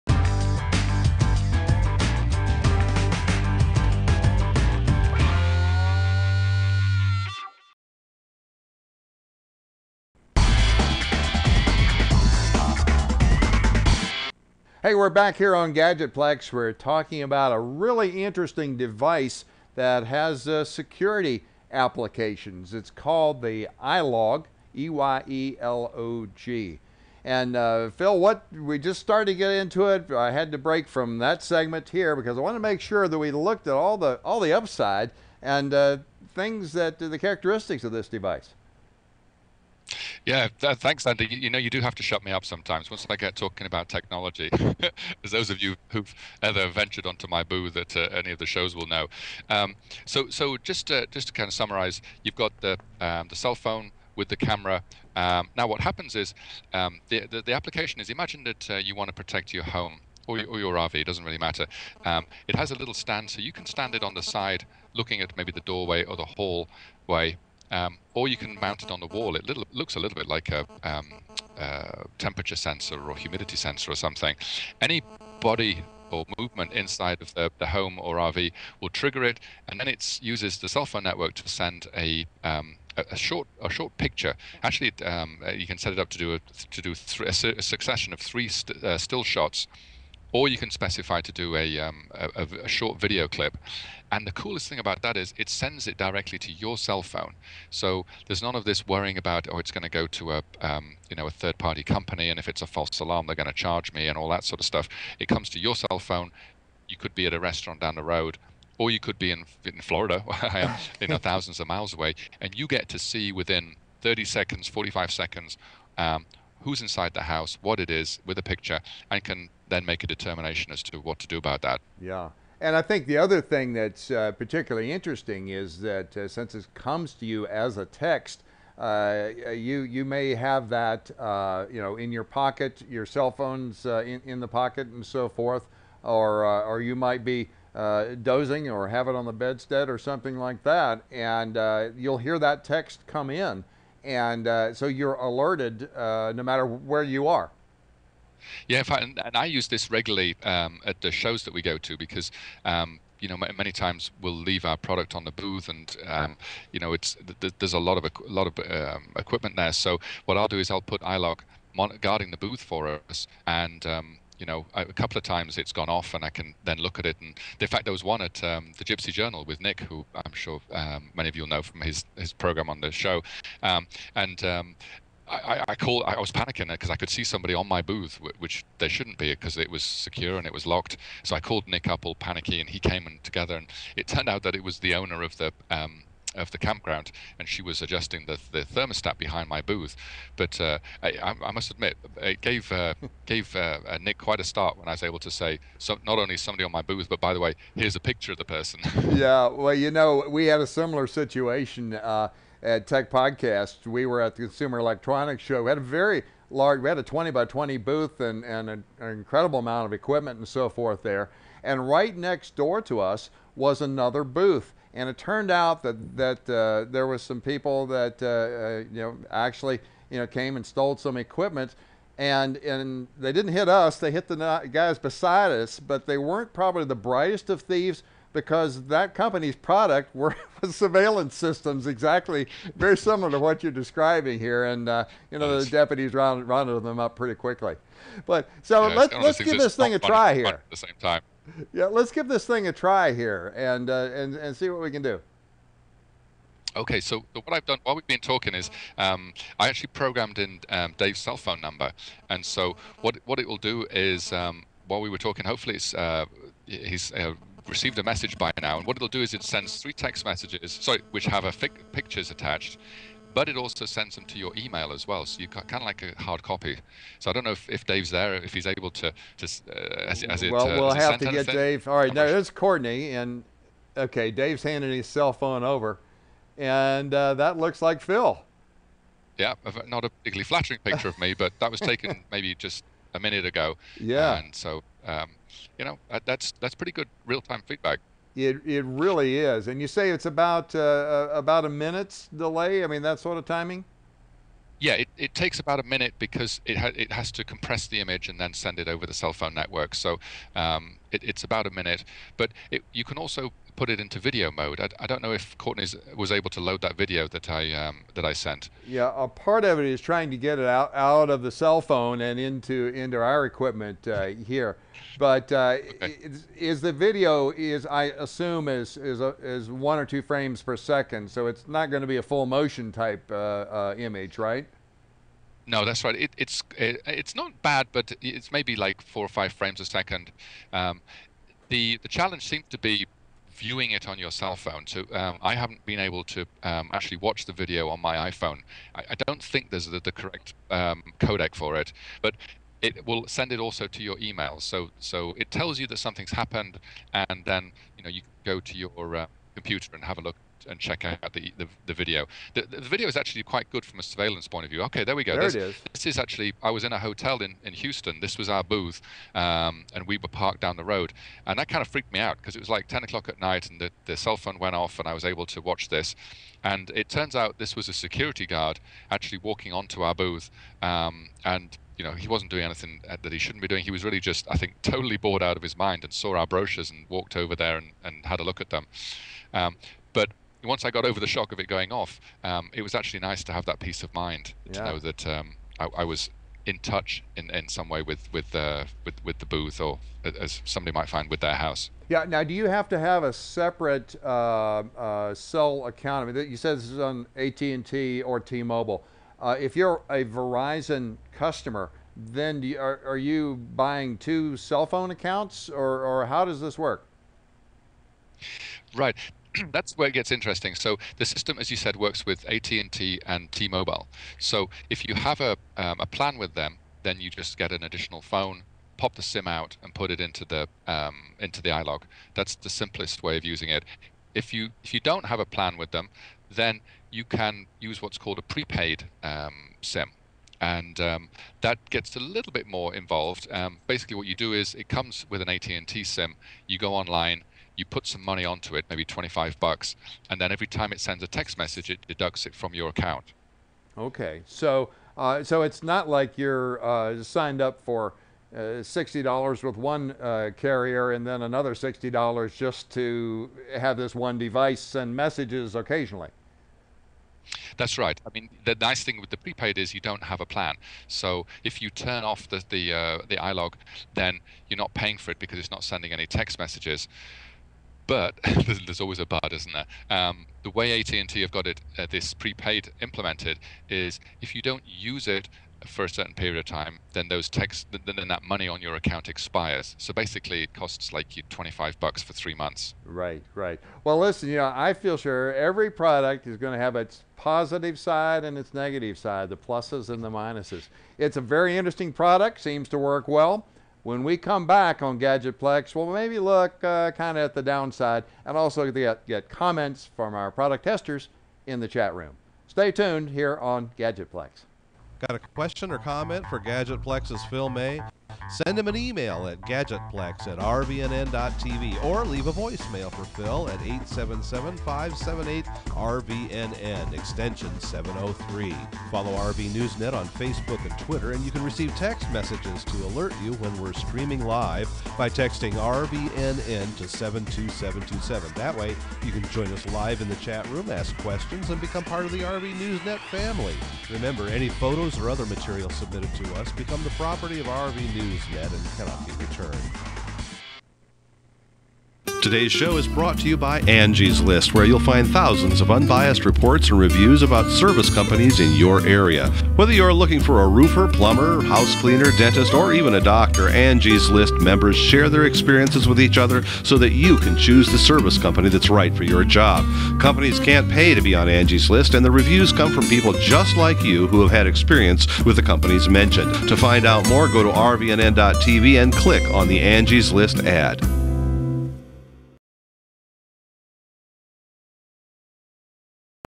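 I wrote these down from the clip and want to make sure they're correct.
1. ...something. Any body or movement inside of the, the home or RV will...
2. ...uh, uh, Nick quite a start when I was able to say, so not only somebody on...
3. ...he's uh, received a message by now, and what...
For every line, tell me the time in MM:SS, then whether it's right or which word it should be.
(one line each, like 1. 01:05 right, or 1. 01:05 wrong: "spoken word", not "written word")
1. 01:13 right
2. 03:13 right
3. 04:16 right.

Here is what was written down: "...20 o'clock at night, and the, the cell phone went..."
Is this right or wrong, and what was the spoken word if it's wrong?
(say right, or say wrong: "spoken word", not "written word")
wrong: "10", not "20".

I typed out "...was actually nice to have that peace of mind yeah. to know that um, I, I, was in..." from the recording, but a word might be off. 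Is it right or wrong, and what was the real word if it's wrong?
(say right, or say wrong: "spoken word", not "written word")
right.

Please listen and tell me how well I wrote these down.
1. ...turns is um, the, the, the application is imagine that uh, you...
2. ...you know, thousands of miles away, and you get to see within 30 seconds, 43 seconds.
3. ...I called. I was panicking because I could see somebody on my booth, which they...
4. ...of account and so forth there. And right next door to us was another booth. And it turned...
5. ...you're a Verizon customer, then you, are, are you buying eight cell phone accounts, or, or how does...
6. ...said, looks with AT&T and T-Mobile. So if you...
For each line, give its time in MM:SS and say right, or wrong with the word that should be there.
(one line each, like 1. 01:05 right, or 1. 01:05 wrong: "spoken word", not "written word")
1. 00:55 wrong: "happens", not "turns"
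2. 01:50 wrong: "45", not "43"
3. 02:55 right
4. 03:29 wrong: "equipment", not "account"
5. 06:39 wrong: "two", not "eight"
6. 06:51 wrong: "works", not "looks".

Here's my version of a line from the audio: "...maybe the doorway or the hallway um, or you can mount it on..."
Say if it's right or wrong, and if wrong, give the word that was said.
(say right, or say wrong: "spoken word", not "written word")
right.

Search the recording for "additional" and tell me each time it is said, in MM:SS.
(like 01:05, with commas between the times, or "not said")
06:57.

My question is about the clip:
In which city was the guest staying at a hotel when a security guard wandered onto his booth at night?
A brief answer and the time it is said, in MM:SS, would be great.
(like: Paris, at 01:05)
Houston, at 05:57.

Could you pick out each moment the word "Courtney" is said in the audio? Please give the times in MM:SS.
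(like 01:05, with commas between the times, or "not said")
04:32, 05:05.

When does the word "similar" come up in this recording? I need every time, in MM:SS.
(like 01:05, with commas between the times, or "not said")
03:20, 03:52.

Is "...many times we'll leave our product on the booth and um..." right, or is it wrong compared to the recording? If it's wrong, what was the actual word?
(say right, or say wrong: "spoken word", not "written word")
right.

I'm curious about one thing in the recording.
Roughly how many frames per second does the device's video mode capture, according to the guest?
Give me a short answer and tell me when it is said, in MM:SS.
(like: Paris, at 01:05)
4 or 5, at 05:29.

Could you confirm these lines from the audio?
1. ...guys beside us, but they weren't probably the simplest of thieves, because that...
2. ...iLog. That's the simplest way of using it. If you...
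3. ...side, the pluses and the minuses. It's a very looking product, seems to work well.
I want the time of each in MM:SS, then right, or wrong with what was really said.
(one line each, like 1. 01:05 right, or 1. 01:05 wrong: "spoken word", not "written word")
1. 03:44 wrong: "brightest", not "simplest"
2. 07:01 right
3. 08:09 wrong: "interesting", not "looking".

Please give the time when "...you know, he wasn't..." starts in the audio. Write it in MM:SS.
06:11.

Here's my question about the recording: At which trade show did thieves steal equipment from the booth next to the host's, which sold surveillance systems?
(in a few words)
Consumer Electronics Show.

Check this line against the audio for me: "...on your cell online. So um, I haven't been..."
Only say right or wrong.
wrong.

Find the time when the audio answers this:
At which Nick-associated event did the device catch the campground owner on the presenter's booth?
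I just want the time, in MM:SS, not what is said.
02:48.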